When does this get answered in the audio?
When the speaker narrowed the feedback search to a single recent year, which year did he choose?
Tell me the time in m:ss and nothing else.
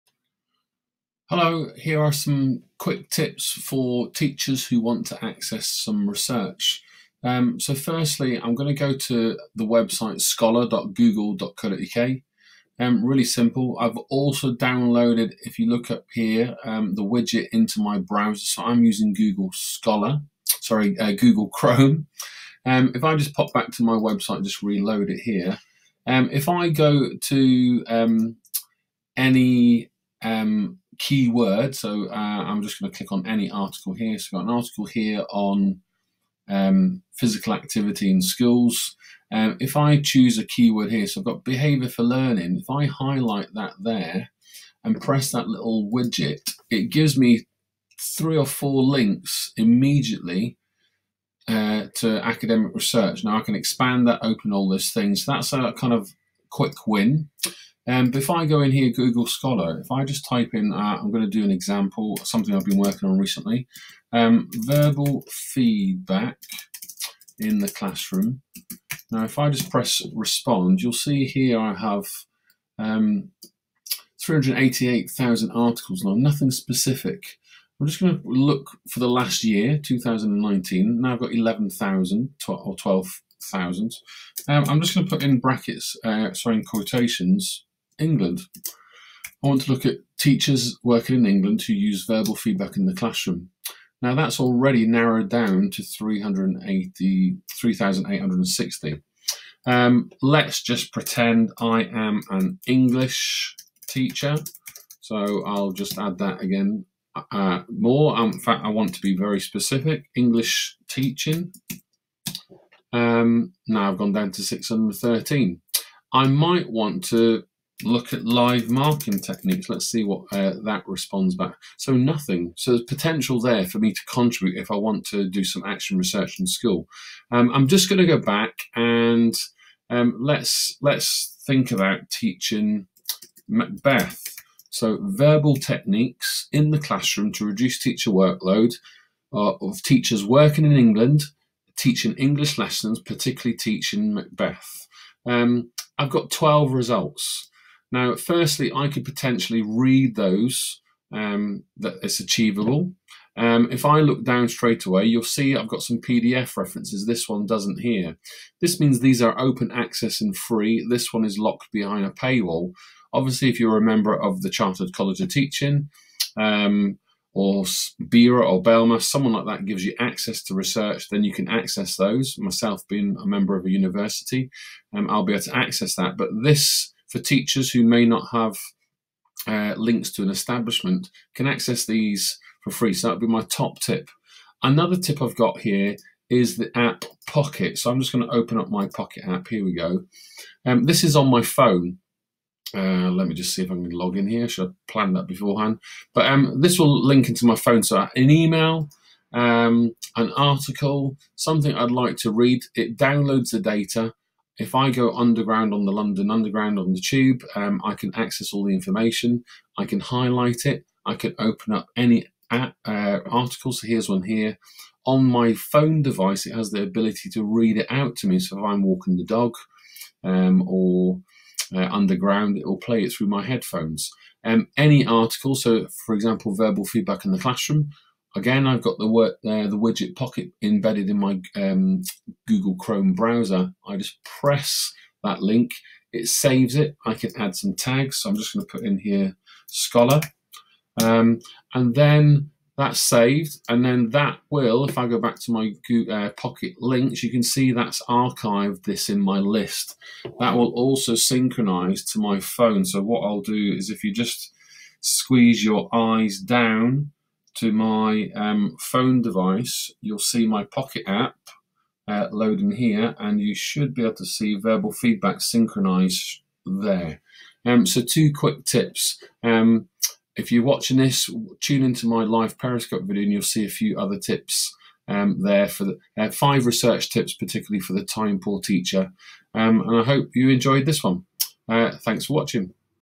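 1:19.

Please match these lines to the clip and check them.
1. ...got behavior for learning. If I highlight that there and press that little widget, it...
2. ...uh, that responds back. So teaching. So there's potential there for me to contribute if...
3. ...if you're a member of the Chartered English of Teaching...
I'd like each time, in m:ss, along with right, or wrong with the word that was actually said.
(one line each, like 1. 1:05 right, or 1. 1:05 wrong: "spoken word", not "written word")
1. 0:41 right
2. 2:00 wrong: "nothing", not "teaching"
3. 2:43 wrong: "College", not "English".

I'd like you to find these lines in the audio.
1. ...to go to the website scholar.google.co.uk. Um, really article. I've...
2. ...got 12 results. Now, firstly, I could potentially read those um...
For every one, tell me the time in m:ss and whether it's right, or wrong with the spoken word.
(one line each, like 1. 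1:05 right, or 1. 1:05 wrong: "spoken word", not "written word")
1. 0:08 wrong: "simple", not "article"
2. 2:26 right.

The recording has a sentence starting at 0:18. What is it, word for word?
So I'm using Google Scholar, sorry, uh, Google Chrome.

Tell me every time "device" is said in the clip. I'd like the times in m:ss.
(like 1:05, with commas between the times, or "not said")
3:36, 4:19.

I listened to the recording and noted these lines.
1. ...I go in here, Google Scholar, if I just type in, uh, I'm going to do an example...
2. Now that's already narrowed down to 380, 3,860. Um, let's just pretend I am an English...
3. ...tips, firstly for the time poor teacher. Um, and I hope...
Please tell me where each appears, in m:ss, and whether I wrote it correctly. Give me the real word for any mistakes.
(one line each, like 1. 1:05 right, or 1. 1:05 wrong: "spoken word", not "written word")
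1. 0:58 right
2. 1:34 right
3. 4:37 wrong: "particularly", not "firstly".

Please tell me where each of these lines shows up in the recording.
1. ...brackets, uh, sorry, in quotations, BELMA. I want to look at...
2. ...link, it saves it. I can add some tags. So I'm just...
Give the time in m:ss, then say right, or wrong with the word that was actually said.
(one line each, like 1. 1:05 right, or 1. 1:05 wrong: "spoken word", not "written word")
1. 1:25 wrong: "England", not "BELMA"
2. 3:55 right.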